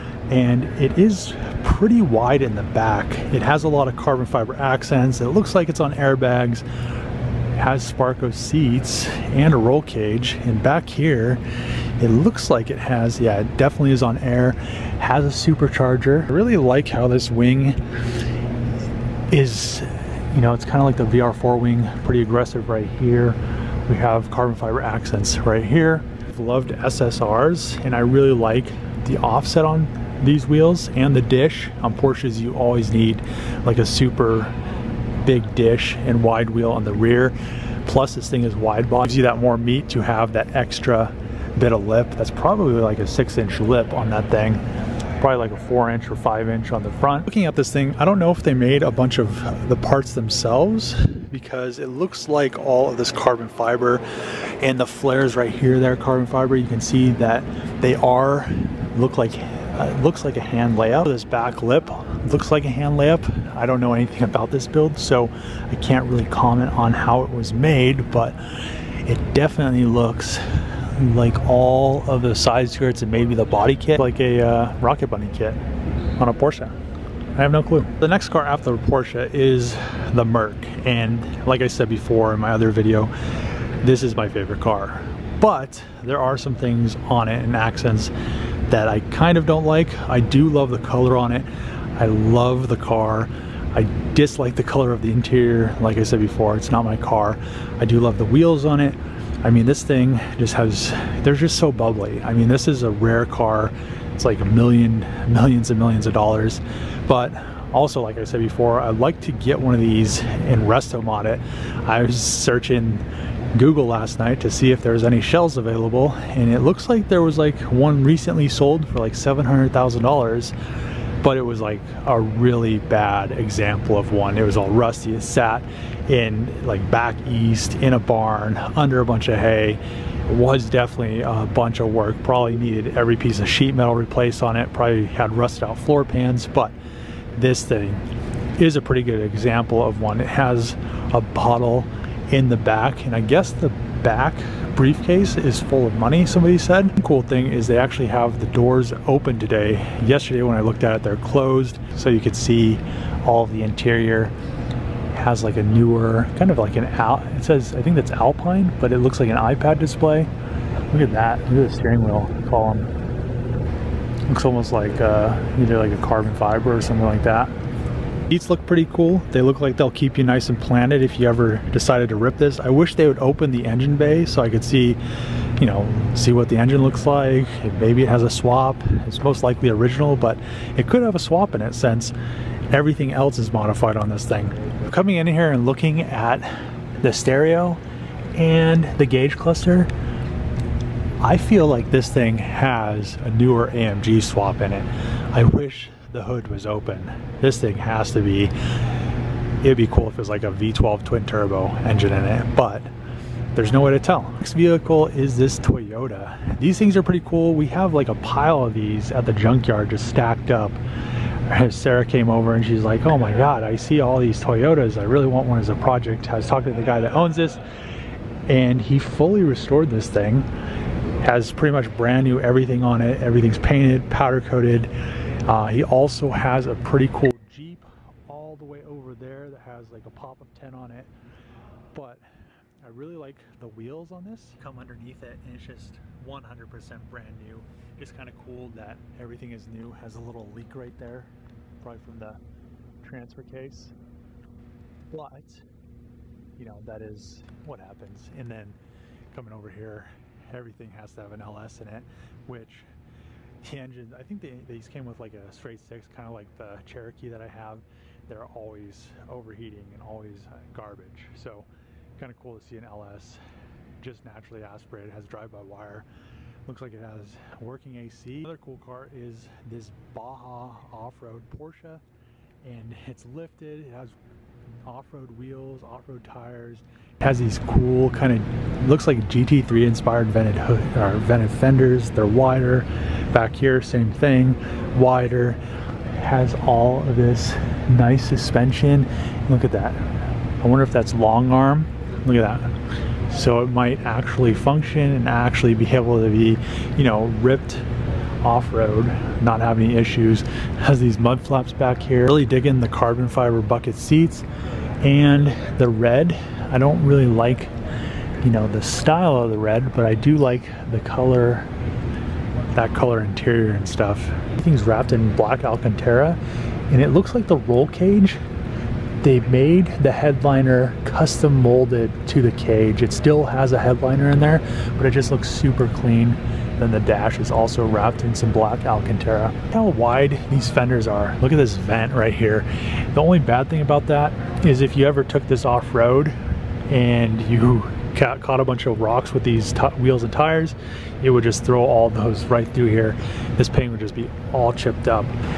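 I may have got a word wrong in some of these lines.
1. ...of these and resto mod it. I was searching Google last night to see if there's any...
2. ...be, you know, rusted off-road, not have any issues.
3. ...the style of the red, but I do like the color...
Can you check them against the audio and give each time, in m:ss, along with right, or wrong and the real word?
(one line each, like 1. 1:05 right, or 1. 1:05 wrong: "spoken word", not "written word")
1. 1:49 right
2. 4:56 wrong: "ripped", not "rusted"
3. 5:08 right.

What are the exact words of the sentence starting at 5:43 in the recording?
This paint would just be all chipped up.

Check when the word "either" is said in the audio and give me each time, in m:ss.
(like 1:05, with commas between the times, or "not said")
2:45.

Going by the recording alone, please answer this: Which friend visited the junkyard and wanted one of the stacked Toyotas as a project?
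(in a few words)
Sarah.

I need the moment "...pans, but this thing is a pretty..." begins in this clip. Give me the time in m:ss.
2:16.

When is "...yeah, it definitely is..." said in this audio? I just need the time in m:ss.
0:13.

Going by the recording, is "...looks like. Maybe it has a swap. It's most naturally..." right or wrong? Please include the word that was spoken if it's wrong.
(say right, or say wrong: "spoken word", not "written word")
wrong: "likely", not "naturally".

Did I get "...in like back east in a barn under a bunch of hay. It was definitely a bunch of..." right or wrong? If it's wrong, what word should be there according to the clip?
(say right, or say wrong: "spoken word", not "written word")
right.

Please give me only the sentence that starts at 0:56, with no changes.
You can see that they are, look like, uh, looks like a hand layup.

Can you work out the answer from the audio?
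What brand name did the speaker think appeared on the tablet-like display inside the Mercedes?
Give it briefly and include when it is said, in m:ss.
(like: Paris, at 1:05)
Alpine, at 2:38.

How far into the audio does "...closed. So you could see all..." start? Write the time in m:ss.
2:31.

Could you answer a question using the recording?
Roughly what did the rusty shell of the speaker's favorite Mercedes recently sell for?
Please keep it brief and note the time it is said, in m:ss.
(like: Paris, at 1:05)
$700,000, at 1:59.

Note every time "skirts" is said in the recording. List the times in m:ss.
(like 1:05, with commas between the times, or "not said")
1:12.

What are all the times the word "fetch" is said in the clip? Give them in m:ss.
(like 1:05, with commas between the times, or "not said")
not said.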